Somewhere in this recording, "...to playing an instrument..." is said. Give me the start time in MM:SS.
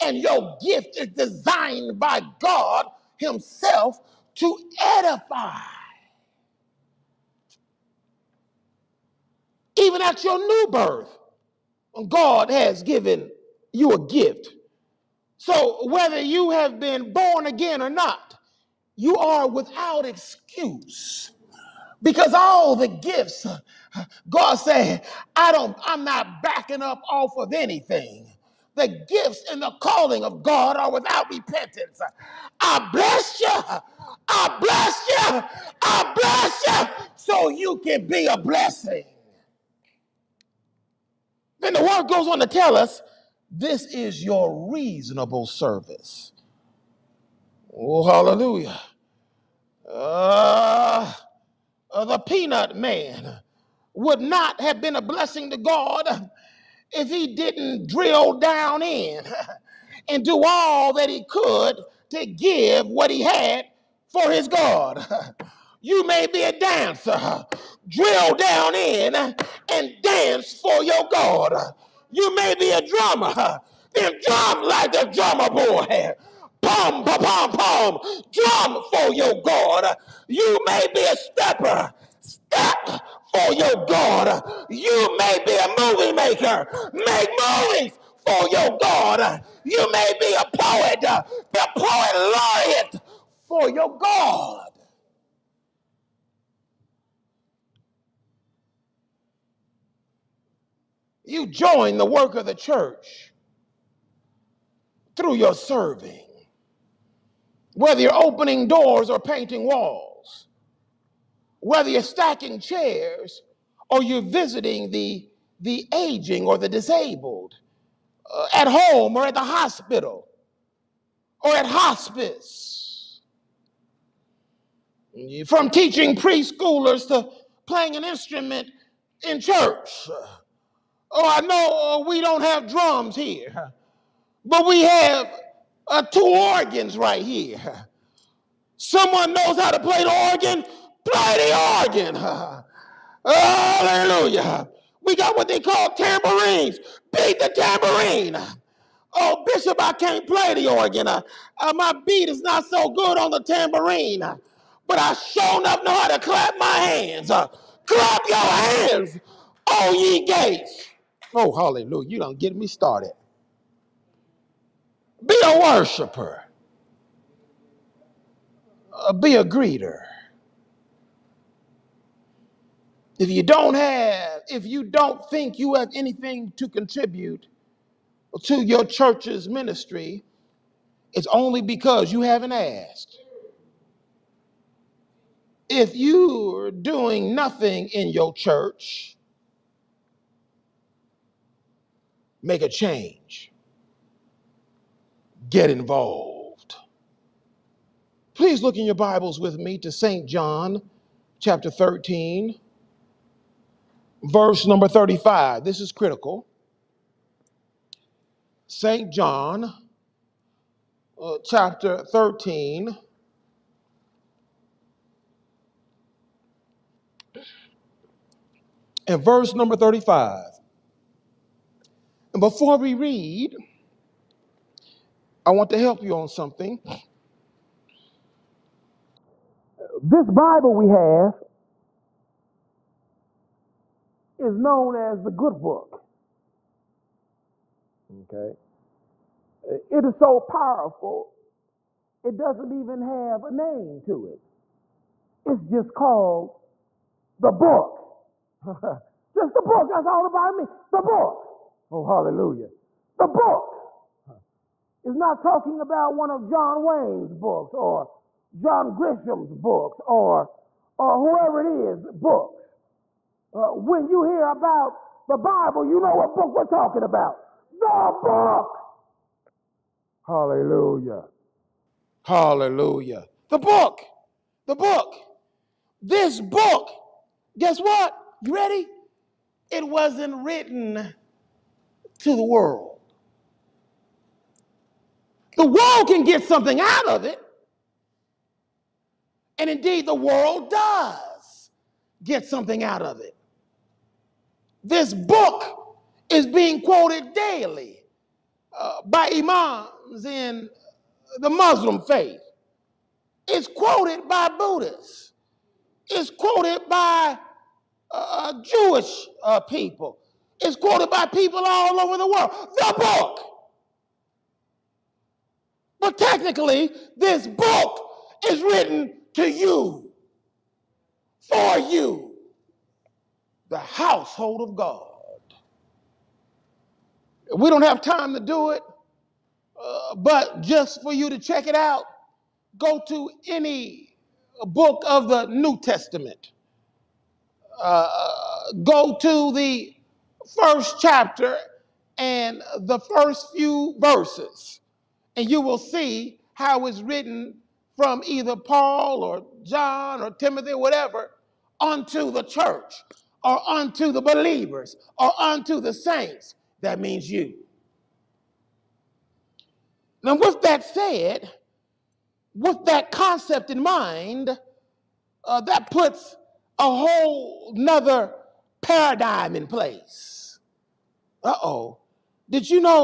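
02:07.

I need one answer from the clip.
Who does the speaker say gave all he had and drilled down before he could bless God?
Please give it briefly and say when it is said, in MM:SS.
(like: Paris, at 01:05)
the peanut man, at 00:52.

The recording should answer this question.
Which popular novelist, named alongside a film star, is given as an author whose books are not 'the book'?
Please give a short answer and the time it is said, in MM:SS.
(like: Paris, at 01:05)
John Grisham, at 04:18.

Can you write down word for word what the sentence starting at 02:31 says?
Uh, uh my beat is not so good on the tambourine, uh, but I sure enough know how to clap my hands.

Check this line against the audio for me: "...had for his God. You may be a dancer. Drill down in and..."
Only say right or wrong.
right.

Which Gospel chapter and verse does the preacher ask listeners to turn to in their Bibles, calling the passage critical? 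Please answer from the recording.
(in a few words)
John 13:35.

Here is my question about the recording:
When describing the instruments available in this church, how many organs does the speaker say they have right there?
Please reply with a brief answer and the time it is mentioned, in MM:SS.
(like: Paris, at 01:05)
2, at 02:16.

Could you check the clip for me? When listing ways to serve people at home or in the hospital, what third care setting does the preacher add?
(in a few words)
hospice.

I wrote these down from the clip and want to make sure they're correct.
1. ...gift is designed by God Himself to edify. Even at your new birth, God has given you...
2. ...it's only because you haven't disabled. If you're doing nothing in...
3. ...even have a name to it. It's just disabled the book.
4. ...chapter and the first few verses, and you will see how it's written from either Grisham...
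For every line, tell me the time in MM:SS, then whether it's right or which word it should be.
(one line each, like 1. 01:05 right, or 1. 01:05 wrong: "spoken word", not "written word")
1. 00:00 right
2. 03:01 wrong: "asked", not "disabled"
3. 04:02 wrong: "called", not "disabled"
4. 05:40 wrong: "Paul", not "Grisham".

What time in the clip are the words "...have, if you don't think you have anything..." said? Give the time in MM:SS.
02:53.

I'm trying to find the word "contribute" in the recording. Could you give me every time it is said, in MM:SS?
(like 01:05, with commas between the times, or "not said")
02:56.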